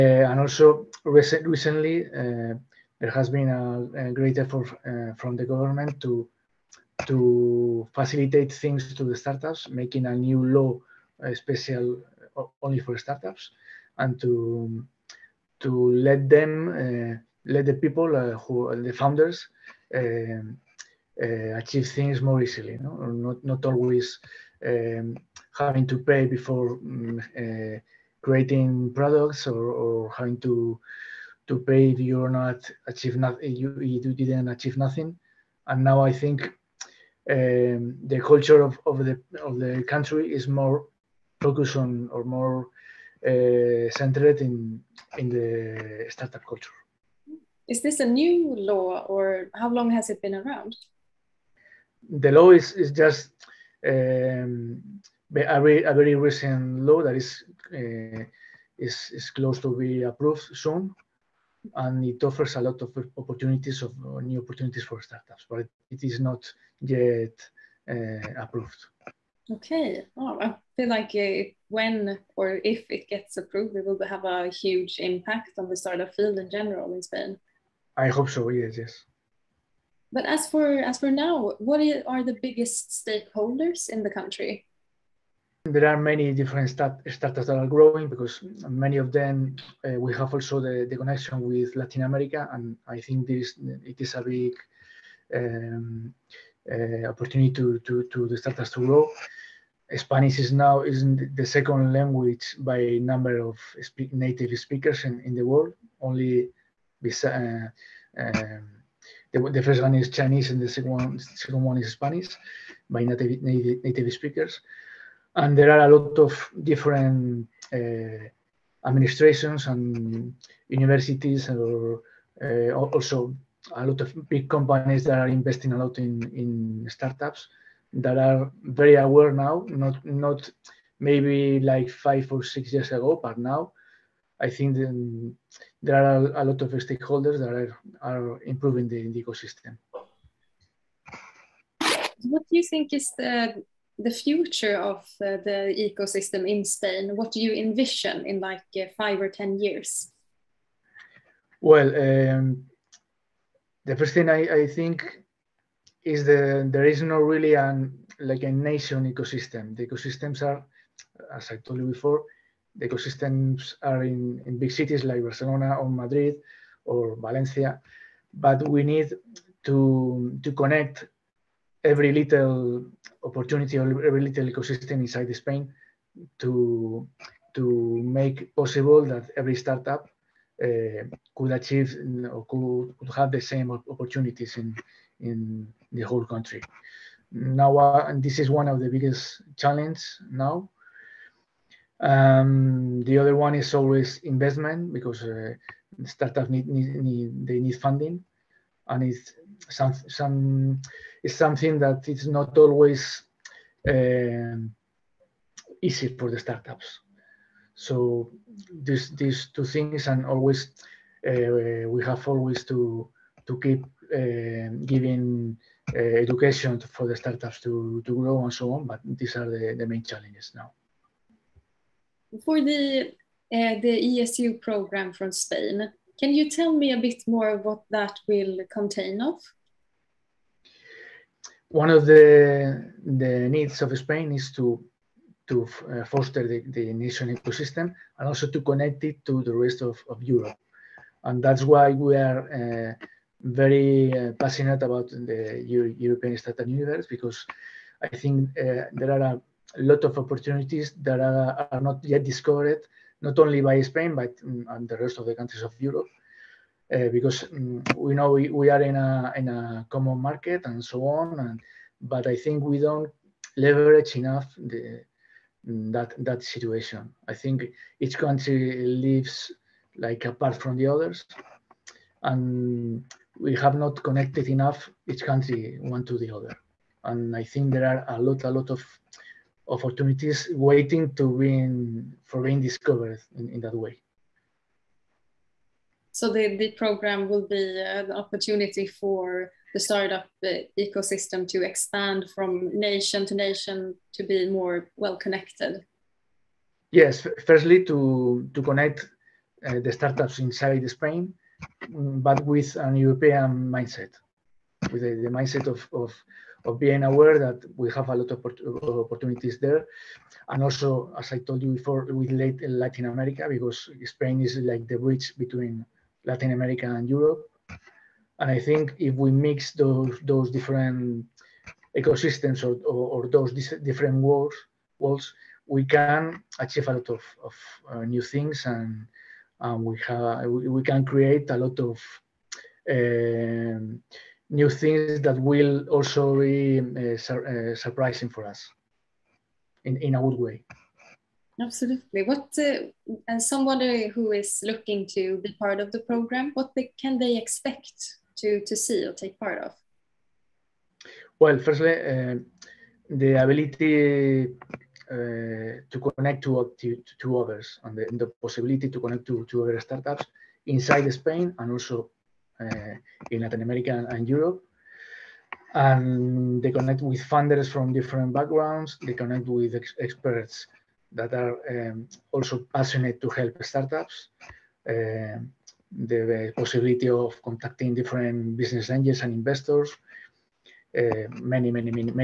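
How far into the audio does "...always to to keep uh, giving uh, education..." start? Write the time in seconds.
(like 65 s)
212 s.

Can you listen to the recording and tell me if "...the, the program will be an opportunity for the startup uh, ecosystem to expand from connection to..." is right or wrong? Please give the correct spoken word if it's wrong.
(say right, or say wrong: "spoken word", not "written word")
wrong: "nation", not "connection".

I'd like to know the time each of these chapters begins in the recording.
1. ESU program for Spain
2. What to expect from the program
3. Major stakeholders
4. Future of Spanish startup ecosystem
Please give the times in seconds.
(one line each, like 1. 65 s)
1. 227 s
2. 347 s
3. 81 s
4. 149 s.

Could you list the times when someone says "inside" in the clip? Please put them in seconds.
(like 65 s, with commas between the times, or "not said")
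175 s, 300 s, 360 s.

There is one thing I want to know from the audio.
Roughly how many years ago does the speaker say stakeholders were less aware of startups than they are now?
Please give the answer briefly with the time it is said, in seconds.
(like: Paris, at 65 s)
5 or 6 years, at 131 s.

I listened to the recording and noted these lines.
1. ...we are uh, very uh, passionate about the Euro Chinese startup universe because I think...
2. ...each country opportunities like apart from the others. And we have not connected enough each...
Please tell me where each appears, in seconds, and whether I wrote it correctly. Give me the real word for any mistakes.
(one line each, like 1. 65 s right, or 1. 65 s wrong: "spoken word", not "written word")
1. 241 s wrong: "European", not "Chinese"
2. 267 s wrong: "lives", not "opportunities".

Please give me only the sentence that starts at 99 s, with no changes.
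Spanish is now is the second language by number of speak, native speakers in, in the world.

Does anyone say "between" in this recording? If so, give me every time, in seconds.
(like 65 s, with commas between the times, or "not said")
315 s.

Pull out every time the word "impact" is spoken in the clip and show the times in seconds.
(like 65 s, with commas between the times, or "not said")
74 s.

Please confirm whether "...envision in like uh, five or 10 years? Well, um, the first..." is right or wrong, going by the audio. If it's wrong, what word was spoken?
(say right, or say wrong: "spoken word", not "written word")
right.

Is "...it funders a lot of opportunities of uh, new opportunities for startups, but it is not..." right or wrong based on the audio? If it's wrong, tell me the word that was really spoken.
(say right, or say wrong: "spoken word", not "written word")
wrong: "offers", not "funders".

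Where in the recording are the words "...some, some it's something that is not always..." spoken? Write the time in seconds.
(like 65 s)
199 s.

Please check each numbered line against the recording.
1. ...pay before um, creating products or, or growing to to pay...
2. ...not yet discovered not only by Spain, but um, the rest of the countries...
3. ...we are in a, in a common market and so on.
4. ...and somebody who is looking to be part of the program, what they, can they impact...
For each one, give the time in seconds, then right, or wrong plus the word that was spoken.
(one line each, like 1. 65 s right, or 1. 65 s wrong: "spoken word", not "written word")
1. 25 s wrong: "having", not "growing"
2. 251 s right
3. 258 s right
4. 343 s wrong: "expect", not "impact".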